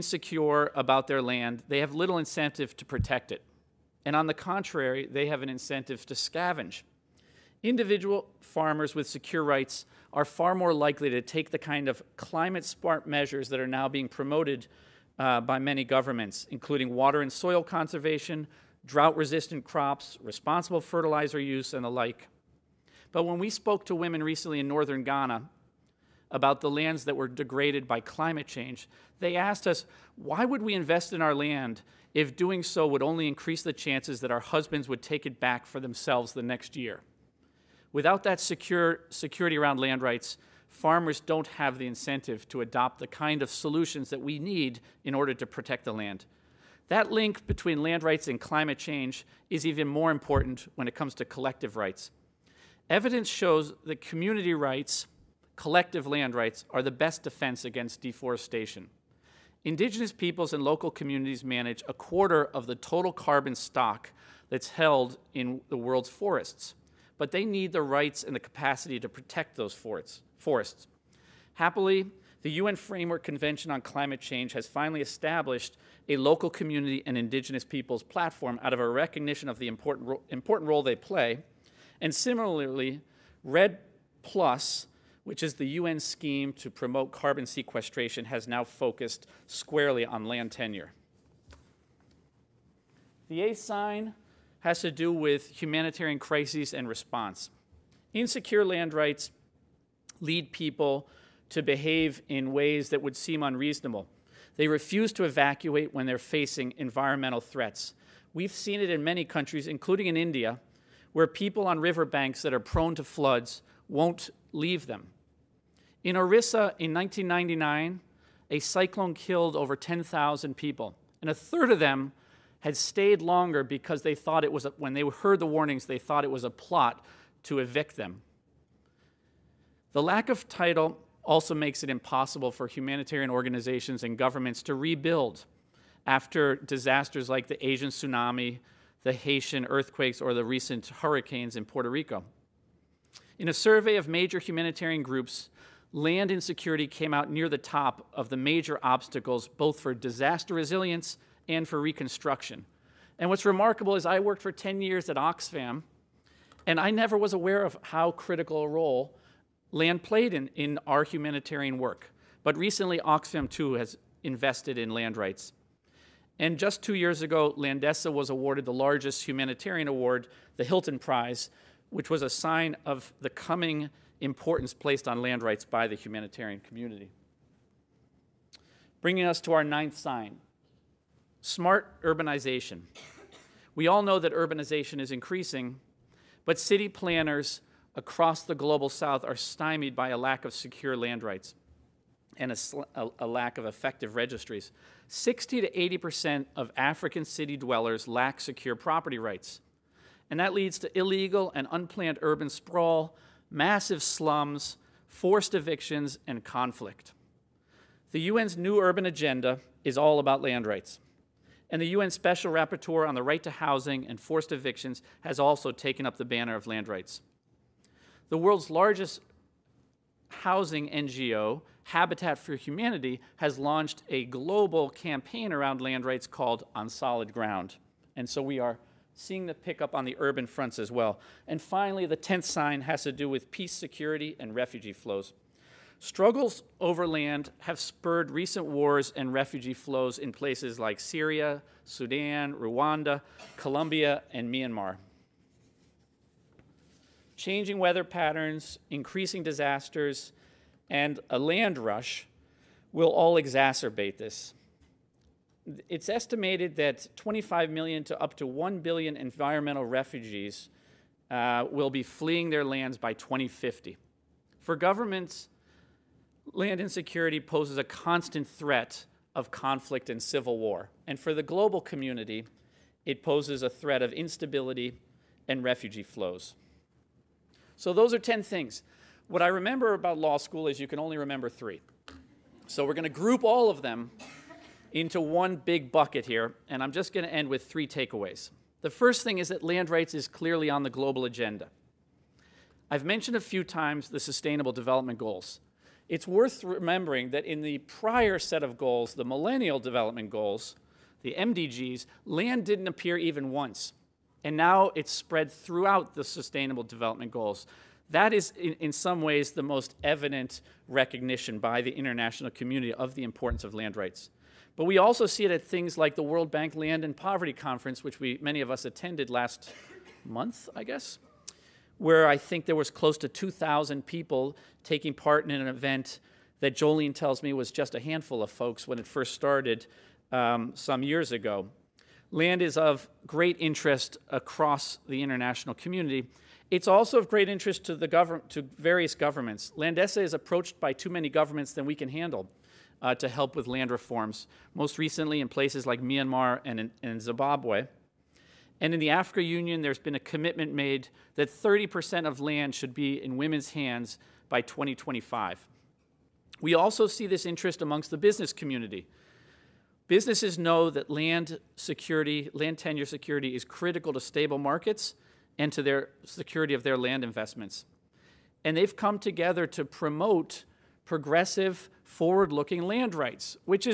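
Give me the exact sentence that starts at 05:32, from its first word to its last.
Land is of great interest across the international community.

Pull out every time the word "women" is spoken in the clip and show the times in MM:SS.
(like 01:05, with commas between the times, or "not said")
00:23, 05:53.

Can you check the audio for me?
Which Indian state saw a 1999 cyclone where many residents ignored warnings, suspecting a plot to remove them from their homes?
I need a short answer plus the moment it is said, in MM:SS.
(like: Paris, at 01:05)
Orissa, at 01:56.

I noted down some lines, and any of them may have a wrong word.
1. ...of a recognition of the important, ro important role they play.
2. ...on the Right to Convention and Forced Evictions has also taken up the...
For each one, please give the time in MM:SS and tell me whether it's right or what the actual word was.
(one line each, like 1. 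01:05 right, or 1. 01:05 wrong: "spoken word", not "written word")
1. 01:18 right
2. 03:33 wrong: "Housing", not "Convention".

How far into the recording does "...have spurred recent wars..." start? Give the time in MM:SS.
03:57.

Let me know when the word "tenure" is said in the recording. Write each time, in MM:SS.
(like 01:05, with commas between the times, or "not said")
01:30, 06:02.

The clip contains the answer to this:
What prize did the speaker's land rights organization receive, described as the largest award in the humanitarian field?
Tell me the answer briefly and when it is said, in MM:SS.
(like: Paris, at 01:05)
Hilton Prize, at 02:50.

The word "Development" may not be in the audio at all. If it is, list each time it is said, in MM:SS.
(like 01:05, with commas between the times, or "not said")
04:54, 04:59, 05:06.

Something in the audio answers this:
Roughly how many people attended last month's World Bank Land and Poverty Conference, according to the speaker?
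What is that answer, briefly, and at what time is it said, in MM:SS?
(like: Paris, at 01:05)
2,000, at 05:23.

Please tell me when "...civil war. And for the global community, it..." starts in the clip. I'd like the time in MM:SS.
04:30.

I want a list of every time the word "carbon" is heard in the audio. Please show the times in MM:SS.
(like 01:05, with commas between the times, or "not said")
01:03, 01:27.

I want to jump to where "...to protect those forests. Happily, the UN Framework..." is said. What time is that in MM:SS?
01:08.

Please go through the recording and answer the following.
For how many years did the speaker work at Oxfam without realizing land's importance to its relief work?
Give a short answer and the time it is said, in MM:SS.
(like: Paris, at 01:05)
10, at 02:34.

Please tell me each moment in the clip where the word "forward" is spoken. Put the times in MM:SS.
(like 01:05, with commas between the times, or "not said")
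06:12.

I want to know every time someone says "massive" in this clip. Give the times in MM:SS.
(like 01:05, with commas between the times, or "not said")
03:23.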